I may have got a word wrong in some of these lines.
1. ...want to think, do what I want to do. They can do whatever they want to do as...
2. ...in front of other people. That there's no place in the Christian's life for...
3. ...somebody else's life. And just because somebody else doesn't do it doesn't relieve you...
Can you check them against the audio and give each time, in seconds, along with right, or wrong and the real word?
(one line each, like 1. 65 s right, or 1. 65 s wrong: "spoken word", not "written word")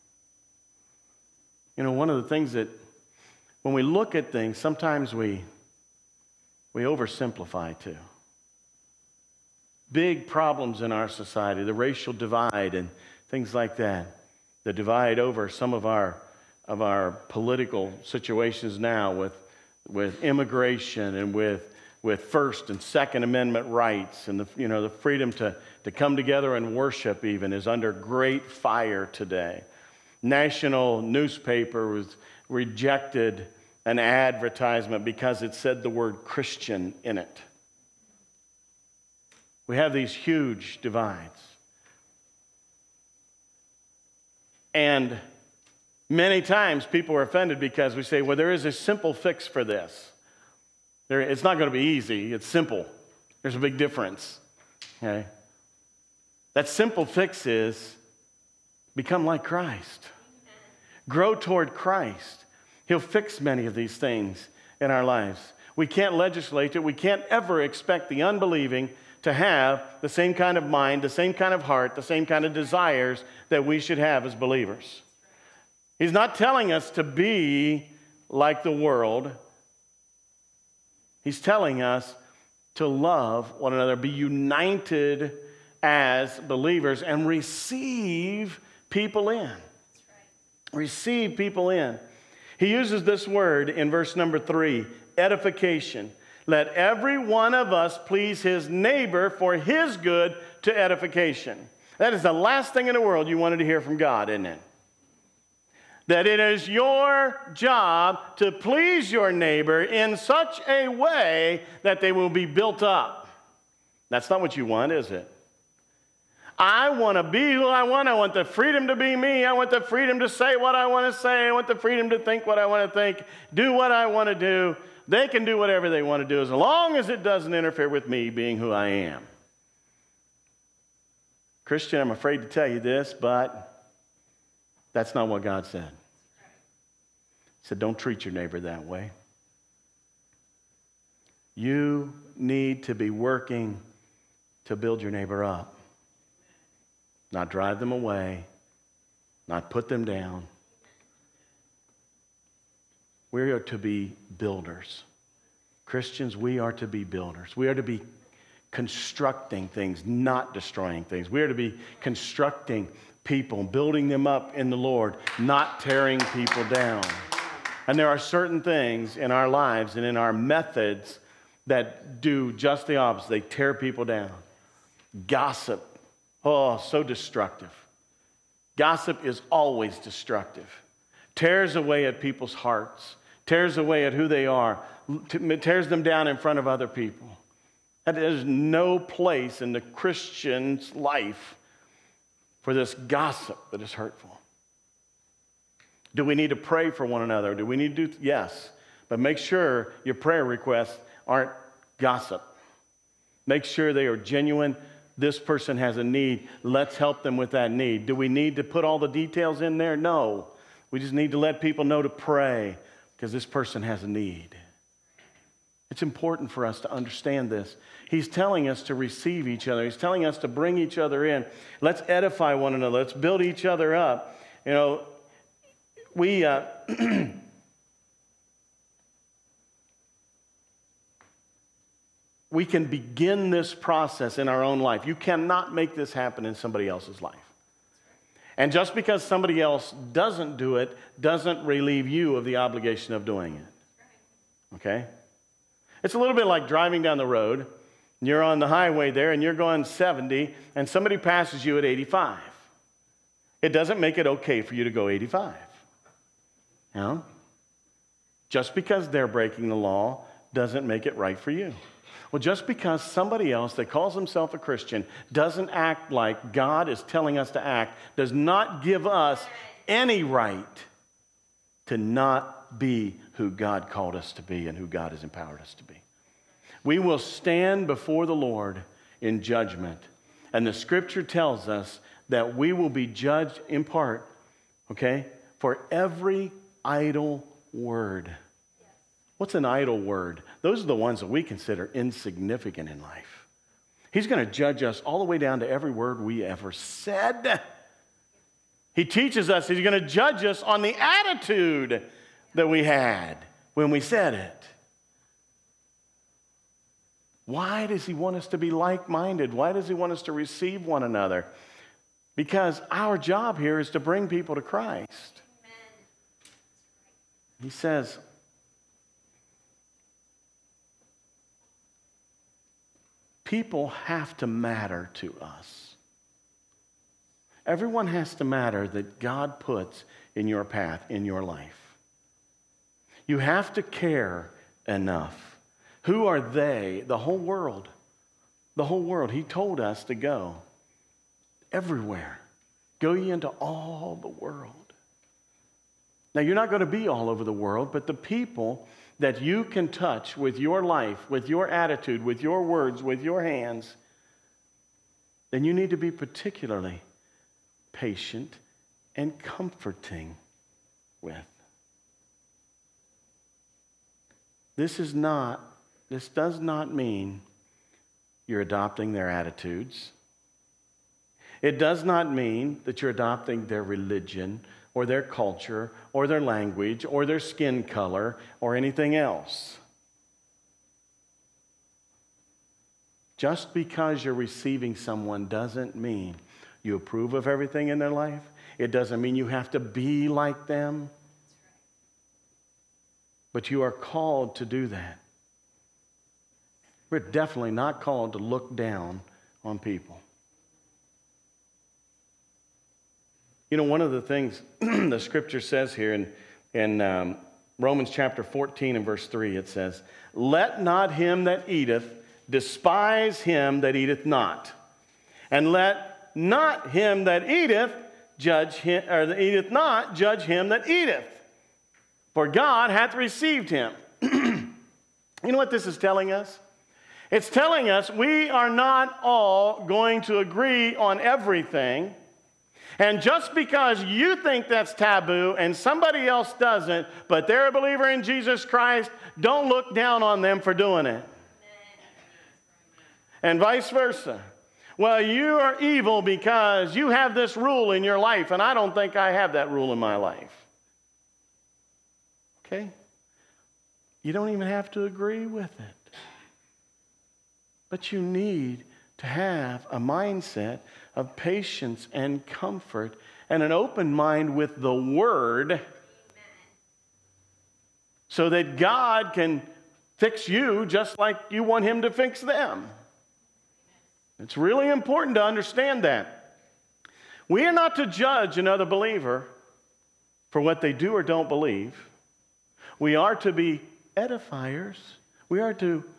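1. 122 s right
2. 186 s right
3. 236 s right.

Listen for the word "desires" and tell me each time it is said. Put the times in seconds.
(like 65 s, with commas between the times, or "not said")
72 s.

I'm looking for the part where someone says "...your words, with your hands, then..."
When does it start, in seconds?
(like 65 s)
352 s.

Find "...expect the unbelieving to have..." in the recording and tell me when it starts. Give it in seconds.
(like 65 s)
67 s.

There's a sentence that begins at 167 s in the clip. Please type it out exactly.
And there are certain things in our lives and in our methods that do just the opposite.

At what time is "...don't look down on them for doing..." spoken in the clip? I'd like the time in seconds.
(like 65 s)
439 s.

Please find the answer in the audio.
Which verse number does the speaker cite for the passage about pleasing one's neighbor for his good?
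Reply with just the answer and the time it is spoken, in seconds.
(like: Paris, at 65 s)
3, at 93 s.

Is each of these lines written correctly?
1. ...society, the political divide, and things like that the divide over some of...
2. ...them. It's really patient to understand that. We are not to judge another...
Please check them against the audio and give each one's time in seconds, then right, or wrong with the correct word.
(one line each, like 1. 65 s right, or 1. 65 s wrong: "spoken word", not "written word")
1. 11 s wrong: "racial", not "political"
2. 472 s wrong: "important", not "patient".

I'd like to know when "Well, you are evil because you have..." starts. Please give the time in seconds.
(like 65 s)
444 s.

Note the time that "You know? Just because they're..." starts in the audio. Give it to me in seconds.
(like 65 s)
256 s.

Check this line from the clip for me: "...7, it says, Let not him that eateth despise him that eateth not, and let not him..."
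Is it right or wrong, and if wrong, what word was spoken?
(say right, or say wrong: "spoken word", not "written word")
wrong: "3", not "7".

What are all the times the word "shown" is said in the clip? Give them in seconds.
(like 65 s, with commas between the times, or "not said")
not said.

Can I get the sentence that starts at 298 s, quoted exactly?
He teaches us, He's going to judge us on the attitude that we had when we said it.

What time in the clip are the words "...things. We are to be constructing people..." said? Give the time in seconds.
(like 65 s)
161 s.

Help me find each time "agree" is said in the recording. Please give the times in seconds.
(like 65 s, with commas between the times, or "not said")
430 s, 455 s.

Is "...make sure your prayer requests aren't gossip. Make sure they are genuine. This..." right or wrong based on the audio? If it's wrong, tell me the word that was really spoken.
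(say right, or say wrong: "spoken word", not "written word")
right.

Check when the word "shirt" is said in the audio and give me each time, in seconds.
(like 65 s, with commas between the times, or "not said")
not said.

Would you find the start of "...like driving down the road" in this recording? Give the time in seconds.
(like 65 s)
246 s.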